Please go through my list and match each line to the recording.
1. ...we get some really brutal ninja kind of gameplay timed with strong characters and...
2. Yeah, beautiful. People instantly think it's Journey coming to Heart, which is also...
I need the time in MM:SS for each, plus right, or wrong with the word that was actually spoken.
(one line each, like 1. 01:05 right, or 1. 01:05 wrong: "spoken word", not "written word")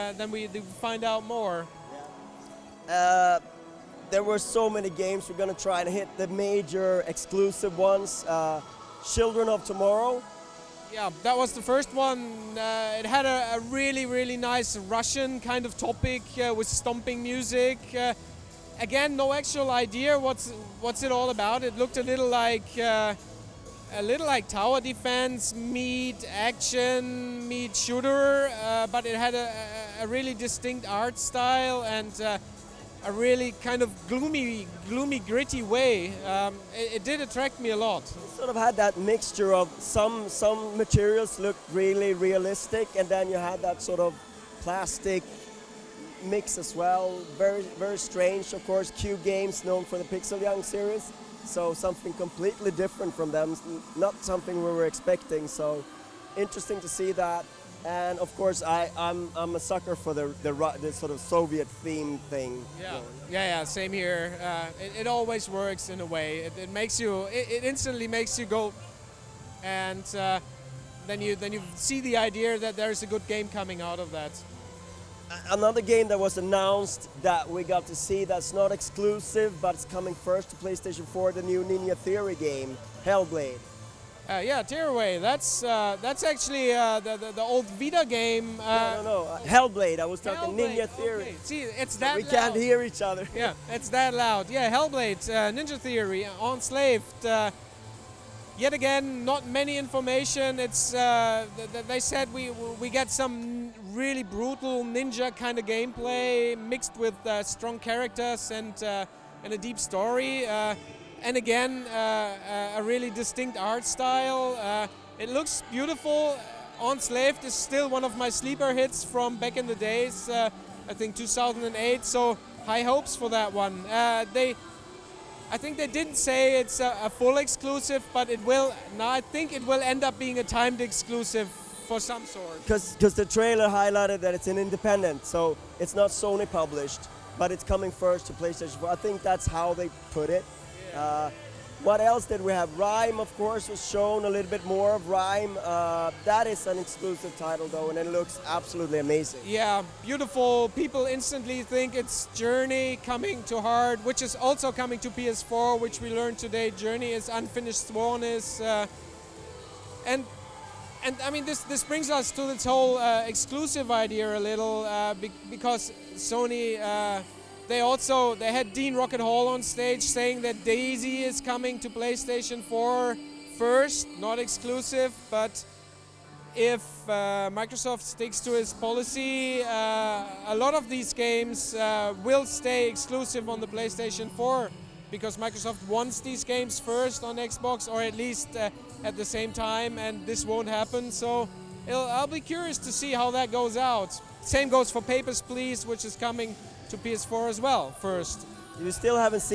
1. 01:42 wrong: "mixed", not "timed"
2. 02:29 right.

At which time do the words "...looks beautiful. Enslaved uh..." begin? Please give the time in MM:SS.
01:55.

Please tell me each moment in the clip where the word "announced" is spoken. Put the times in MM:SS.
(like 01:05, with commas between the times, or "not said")
01:16.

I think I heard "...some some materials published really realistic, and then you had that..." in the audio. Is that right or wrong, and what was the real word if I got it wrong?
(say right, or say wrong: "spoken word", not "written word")
wrong: "looked", not "published".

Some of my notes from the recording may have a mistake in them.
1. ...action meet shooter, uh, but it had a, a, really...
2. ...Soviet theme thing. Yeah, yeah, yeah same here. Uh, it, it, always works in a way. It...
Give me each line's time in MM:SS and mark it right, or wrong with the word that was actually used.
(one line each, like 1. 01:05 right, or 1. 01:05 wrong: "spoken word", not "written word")
1. 00:26 right
2. 01:01 right.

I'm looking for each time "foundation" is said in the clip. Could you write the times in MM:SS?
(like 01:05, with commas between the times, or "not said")
not said.